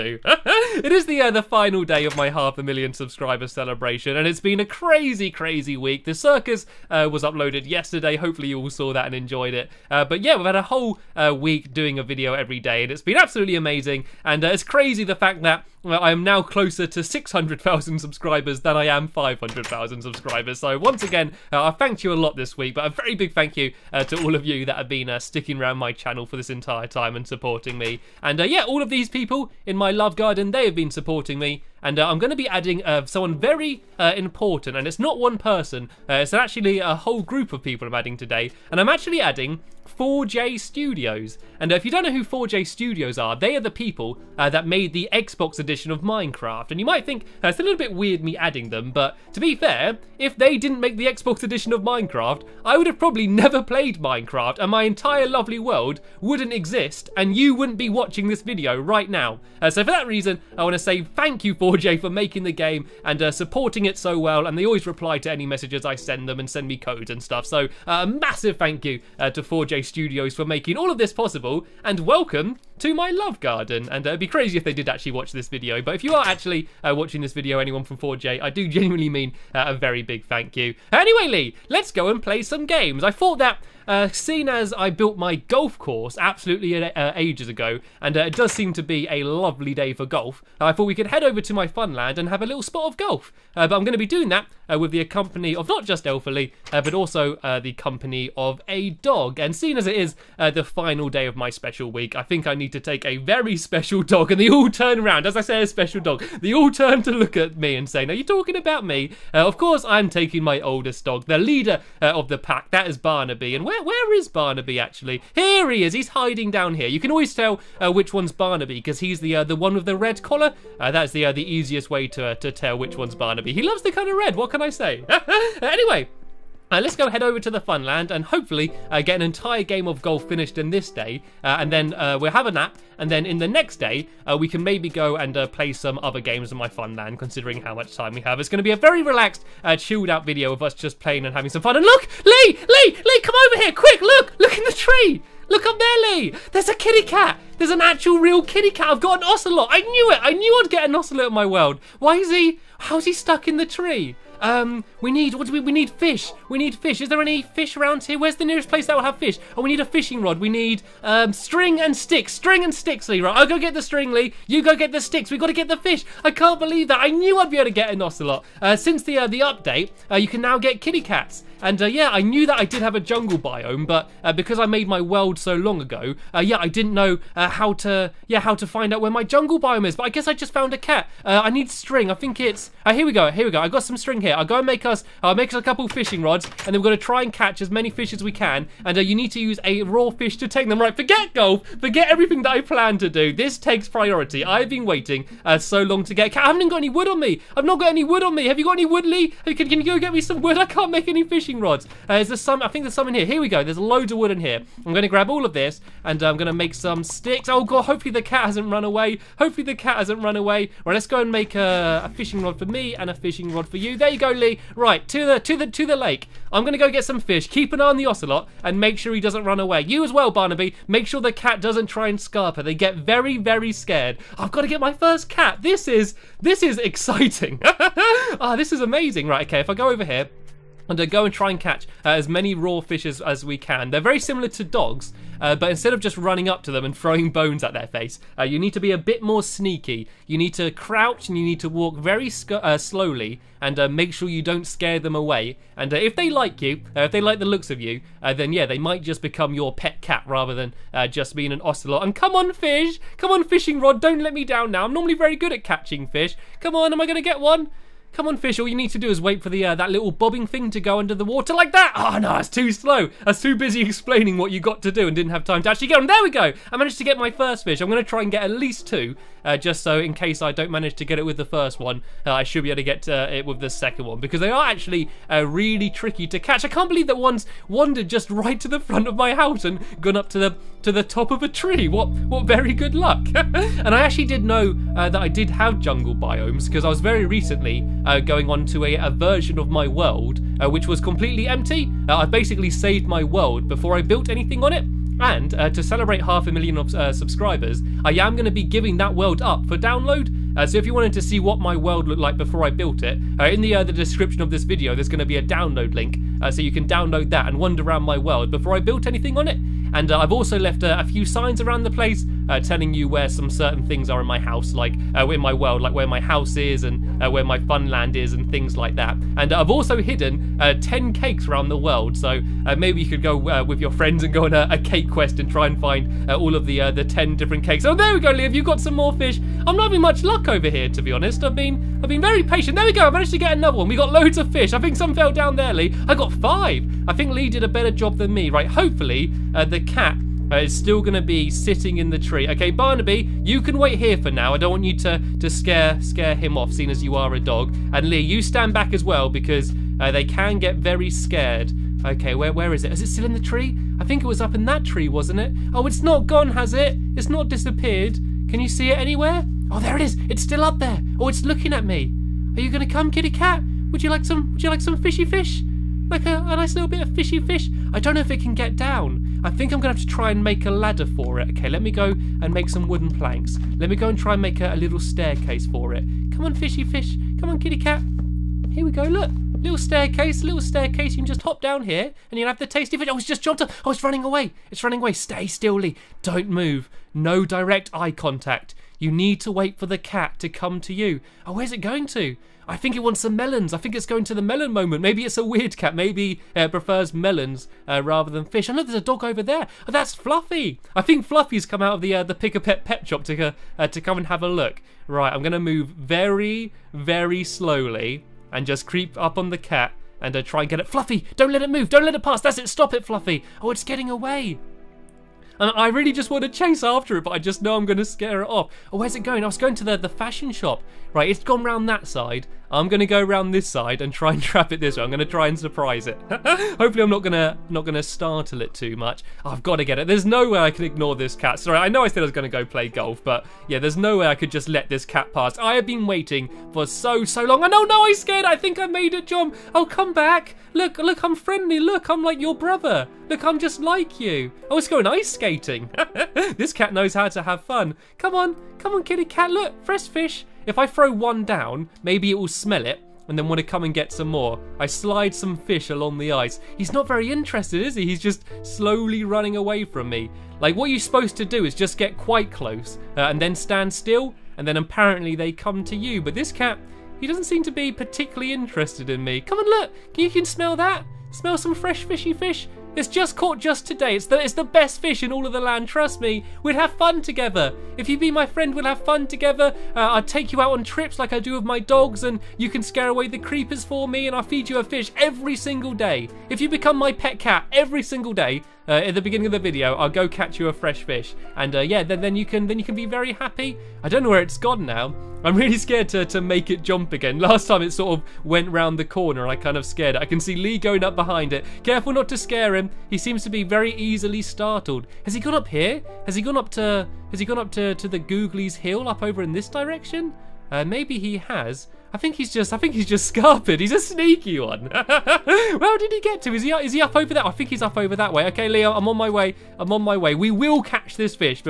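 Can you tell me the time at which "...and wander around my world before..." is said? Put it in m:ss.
5:07.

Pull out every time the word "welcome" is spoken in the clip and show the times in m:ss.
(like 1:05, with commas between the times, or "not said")
1:12.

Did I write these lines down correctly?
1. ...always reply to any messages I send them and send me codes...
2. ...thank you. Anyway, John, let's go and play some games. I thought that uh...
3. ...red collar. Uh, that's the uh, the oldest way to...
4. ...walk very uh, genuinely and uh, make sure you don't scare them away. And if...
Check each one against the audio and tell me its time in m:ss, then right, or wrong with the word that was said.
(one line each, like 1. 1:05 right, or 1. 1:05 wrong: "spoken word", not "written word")
1. 1:04 right
2. 1:20 wrong: "Lee", not "John"
3. 1:59 wrong: "easiest", not "oldest"
4. 4:01 wrong: "slowly", not "genuinely".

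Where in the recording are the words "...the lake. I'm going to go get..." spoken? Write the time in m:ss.
3:35.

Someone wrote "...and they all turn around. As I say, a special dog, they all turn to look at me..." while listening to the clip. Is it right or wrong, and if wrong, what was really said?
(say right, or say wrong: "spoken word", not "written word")
right.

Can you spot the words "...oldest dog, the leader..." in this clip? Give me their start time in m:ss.
1:50.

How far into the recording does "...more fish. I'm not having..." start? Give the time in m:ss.
5:28.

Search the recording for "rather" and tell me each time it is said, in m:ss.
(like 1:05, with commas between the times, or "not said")
4:10, 6:38.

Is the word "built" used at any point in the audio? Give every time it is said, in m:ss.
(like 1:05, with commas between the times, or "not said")
1:24, 4:54, 5:02, 5:08.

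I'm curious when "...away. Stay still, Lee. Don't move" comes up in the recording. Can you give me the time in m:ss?
6:24.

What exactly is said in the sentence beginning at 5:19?
And I've also hidden 10 cakes around the world.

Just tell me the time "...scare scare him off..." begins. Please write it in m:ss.
5:45.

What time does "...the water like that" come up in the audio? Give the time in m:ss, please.
4:21.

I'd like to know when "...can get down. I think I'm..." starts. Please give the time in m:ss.
6:08.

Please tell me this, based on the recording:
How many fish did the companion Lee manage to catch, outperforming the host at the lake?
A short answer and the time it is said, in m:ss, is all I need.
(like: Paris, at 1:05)
5, at 5:36.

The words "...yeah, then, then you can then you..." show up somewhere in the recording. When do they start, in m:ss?
8:11.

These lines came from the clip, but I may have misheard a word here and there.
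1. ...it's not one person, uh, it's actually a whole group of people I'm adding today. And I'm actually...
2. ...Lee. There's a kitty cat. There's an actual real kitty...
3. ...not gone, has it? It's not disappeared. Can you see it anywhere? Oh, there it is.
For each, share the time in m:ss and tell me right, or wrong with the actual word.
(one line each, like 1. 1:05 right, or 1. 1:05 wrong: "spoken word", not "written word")
1. 0:34 right
2. 2:26 right
3. 5:56 right.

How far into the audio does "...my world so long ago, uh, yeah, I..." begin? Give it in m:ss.
2:54.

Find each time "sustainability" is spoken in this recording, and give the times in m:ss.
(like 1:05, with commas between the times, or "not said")
not said.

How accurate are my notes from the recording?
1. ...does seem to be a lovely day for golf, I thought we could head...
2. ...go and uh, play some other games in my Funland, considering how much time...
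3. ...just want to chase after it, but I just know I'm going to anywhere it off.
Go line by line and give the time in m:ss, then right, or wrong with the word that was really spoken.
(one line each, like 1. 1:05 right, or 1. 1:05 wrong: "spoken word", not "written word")
1. 1:28 right
2. 2:14 right
3. 6:56 wrong: "scare", not "anywhere".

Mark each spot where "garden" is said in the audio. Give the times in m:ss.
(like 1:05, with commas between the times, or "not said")
0:30, 1:13.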